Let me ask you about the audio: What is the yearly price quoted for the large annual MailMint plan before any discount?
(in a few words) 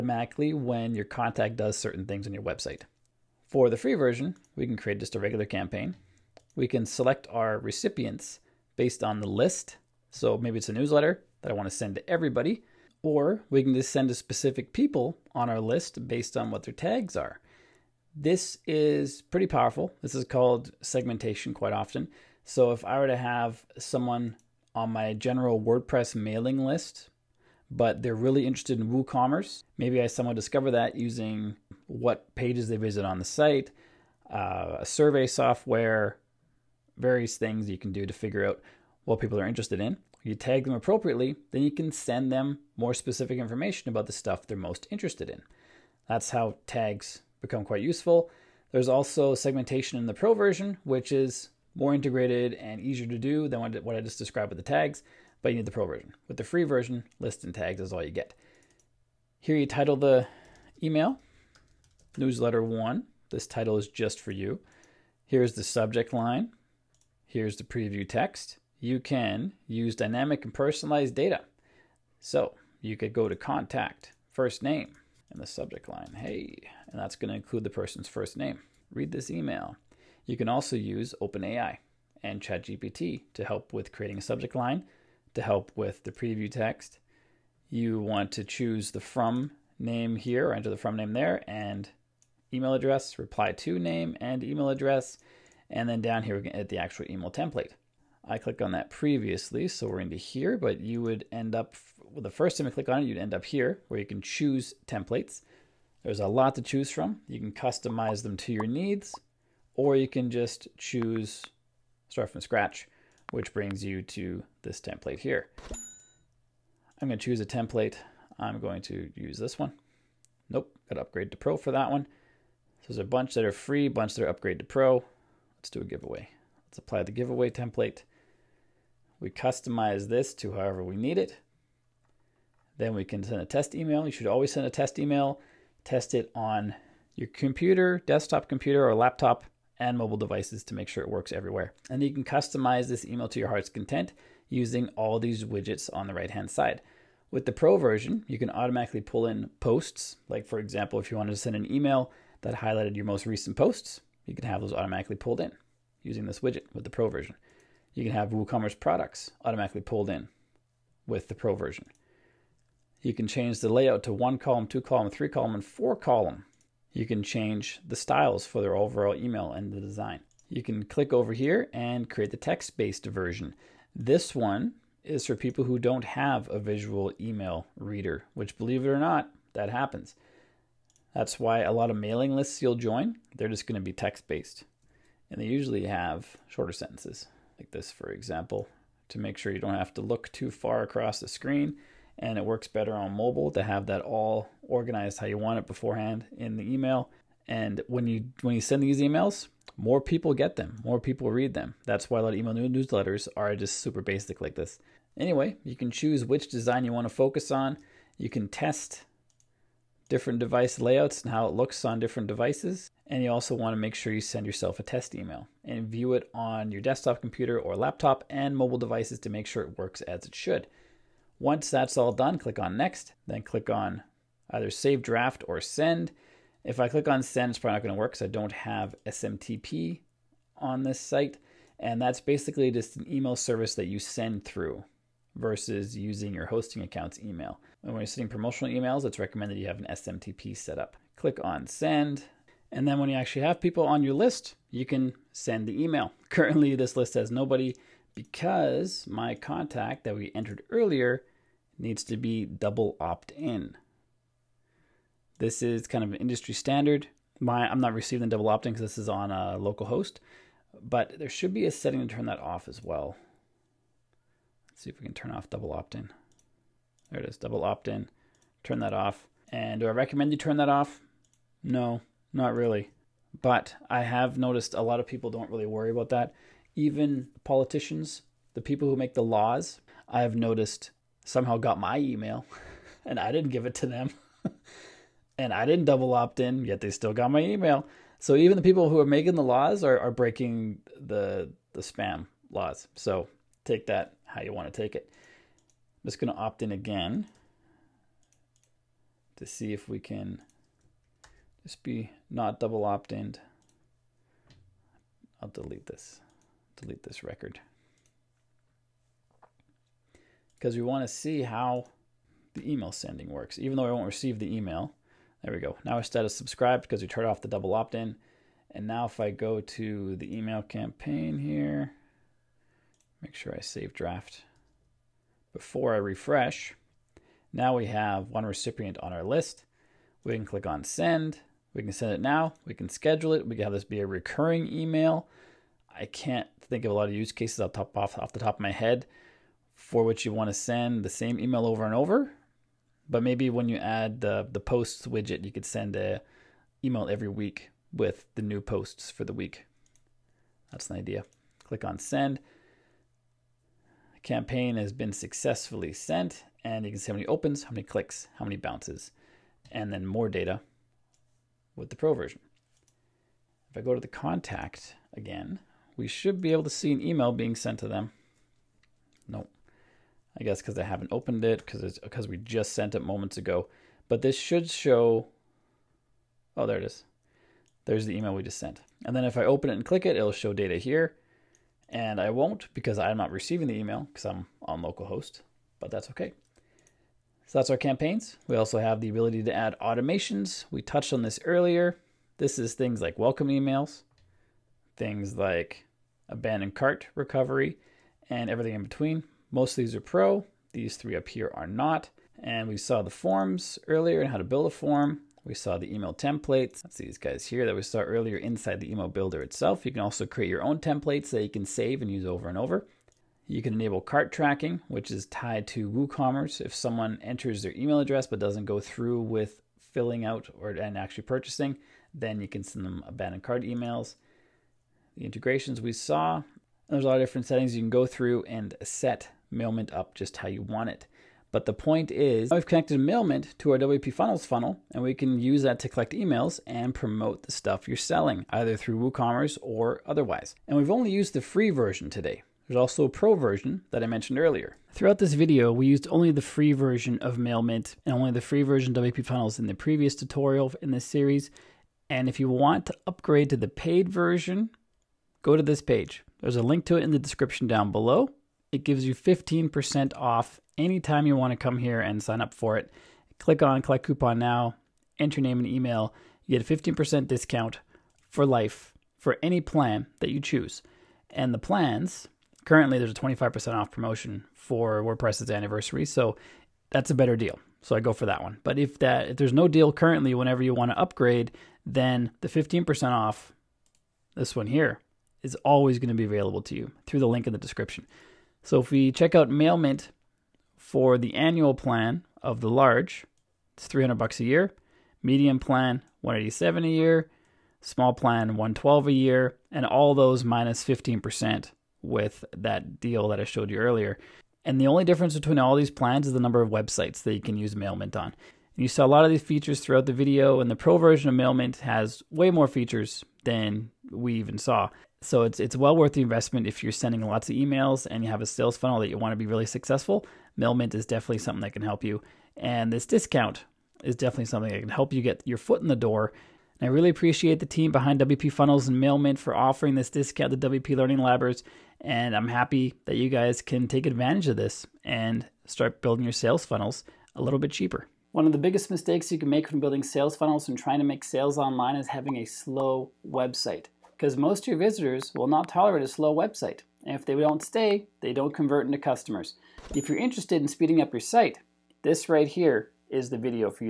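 $300.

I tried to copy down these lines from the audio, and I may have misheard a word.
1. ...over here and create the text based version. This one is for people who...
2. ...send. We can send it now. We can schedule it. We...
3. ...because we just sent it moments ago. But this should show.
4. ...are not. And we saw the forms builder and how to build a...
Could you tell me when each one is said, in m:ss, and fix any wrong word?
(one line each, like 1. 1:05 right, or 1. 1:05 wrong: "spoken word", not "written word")
1. 2:51 right
2. 5:30 right
3. 6:11 right
4. 6:41 wrong: "earlier", not "builder".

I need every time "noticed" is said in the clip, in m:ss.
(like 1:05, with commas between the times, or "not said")
4:34, 4:40.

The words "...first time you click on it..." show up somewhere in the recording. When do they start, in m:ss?
1:42.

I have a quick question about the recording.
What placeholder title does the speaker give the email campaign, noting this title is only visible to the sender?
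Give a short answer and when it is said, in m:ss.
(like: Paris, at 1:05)
Newsletter one, at 1:02.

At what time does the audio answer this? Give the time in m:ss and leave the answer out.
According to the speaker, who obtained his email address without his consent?
4:37.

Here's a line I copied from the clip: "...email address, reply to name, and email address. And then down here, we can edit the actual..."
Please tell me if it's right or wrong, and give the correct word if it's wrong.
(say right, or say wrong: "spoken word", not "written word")
right.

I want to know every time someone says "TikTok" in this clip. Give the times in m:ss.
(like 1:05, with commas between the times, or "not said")
not said.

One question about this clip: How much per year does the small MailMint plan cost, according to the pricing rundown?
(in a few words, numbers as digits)
$112.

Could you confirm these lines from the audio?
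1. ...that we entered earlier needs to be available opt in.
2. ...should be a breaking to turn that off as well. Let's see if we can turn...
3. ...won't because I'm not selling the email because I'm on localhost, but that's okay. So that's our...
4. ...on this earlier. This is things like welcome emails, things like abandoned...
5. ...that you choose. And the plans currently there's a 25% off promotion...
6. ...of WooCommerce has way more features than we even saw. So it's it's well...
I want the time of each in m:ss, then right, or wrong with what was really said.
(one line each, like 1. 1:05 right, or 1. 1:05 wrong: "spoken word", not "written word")
1. 4:10 wrong: "double", not "available"
2. 4:21 wrong: "setting", not "breaking"
3. 6:22 wrong: "receiving", not "selling"
4. 6:31 right
5. 7:50 right
6. 8:31 wrong: "MailMint", not "WooCommerce".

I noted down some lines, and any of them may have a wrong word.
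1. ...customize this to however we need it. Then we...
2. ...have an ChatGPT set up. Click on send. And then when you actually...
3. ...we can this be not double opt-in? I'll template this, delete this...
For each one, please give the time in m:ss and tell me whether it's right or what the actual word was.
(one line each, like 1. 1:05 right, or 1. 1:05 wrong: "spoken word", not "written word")
1. 2:09 right
2. 3:59 wrong: "SMTP", not "ChatGPT"
3. 4:59 wrong: "delete", not "template".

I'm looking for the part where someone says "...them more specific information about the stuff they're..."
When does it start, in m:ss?
0:42.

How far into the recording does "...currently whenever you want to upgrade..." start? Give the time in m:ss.
7:59.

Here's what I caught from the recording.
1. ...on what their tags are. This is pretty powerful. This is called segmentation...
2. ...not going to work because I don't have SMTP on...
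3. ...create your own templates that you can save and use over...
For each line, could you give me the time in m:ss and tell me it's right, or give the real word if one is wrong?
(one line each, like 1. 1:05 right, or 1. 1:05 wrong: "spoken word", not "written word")
1. 0:16 right
2. 3:47 right
3. 6:50 right.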